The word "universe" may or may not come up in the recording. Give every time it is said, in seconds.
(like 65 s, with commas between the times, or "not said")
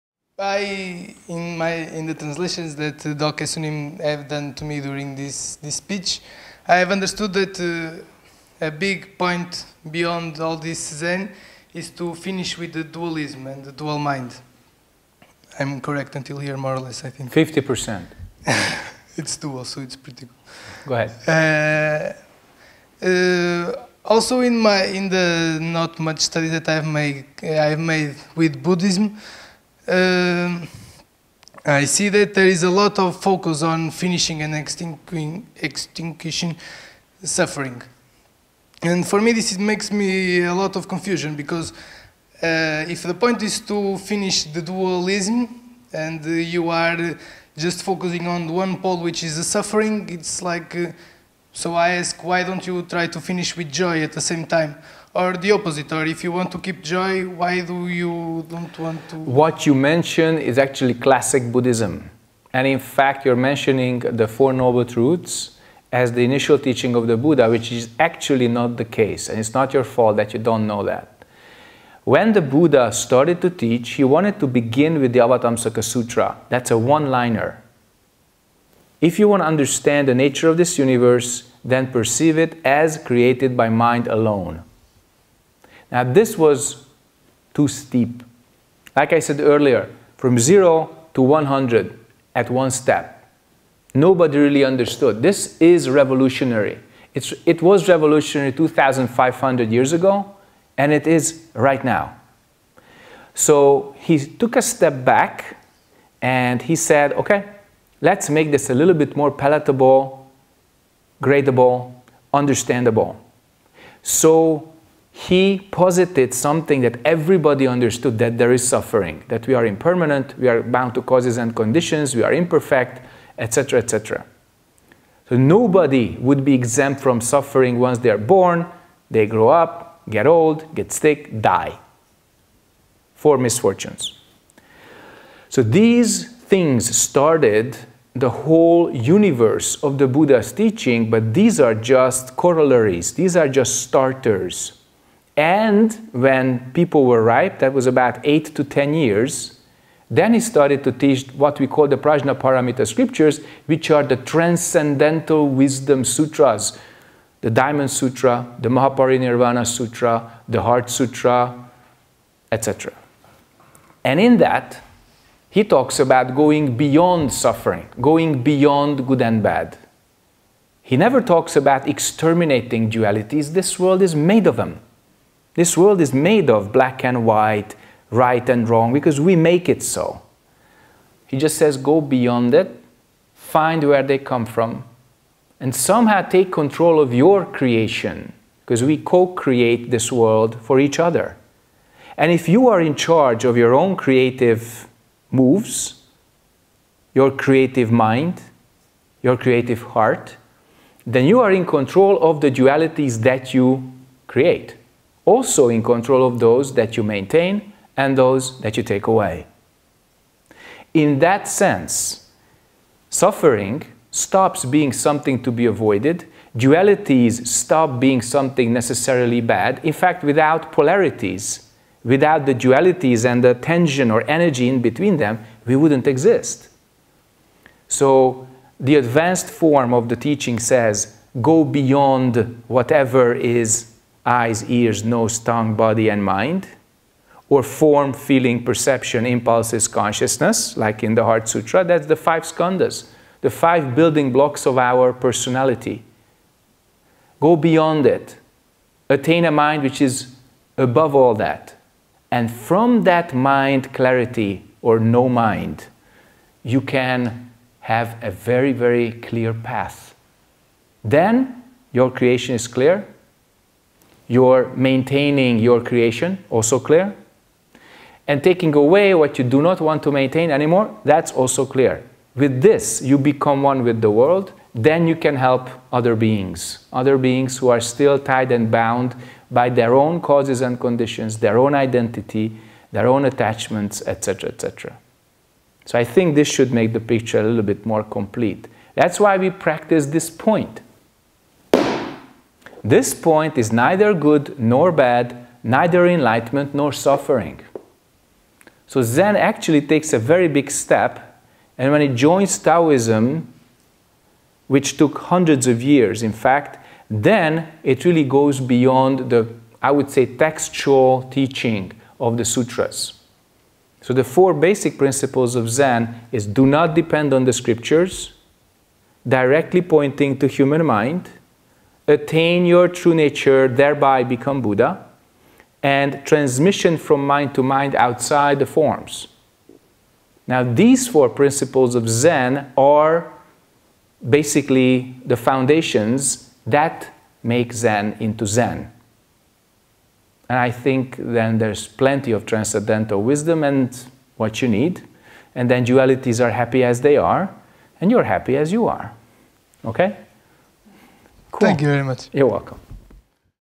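80 s, 138 s.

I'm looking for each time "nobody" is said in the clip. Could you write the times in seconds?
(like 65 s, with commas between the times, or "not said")
93 s, 125 s.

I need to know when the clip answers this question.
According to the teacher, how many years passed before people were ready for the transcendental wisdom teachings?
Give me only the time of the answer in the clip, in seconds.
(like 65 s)
148 s.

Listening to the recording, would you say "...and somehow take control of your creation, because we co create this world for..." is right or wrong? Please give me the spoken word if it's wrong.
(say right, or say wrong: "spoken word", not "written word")
right.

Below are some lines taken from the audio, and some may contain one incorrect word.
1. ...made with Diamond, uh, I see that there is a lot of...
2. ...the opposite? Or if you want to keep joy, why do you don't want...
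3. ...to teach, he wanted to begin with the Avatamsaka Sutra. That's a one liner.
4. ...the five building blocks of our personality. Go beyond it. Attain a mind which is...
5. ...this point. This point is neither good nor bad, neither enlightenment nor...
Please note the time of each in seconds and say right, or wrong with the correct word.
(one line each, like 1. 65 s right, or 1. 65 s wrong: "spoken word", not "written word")
1. 27 s wrong: "Buddhism", not "Diamond"
2. 55 s right
3. 73 s right
4. 243 s right
5. 290 s right.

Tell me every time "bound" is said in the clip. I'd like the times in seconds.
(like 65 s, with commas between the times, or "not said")
120 s, 278 s.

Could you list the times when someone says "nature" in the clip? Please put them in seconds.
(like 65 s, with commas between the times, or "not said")
80 s, 323 s.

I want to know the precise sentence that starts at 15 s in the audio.
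I'm correct until here, more or less, I think.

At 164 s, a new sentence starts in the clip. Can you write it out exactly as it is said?
And in that, he talks about going beyond suffering, going beyond good and bad.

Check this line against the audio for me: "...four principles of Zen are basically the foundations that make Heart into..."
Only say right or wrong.
wrong.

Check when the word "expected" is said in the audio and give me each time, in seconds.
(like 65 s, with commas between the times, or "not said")
not said.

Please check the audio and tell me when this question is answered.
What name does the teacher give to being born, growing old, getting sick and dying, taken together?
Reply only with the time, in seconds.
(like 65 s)
133 s.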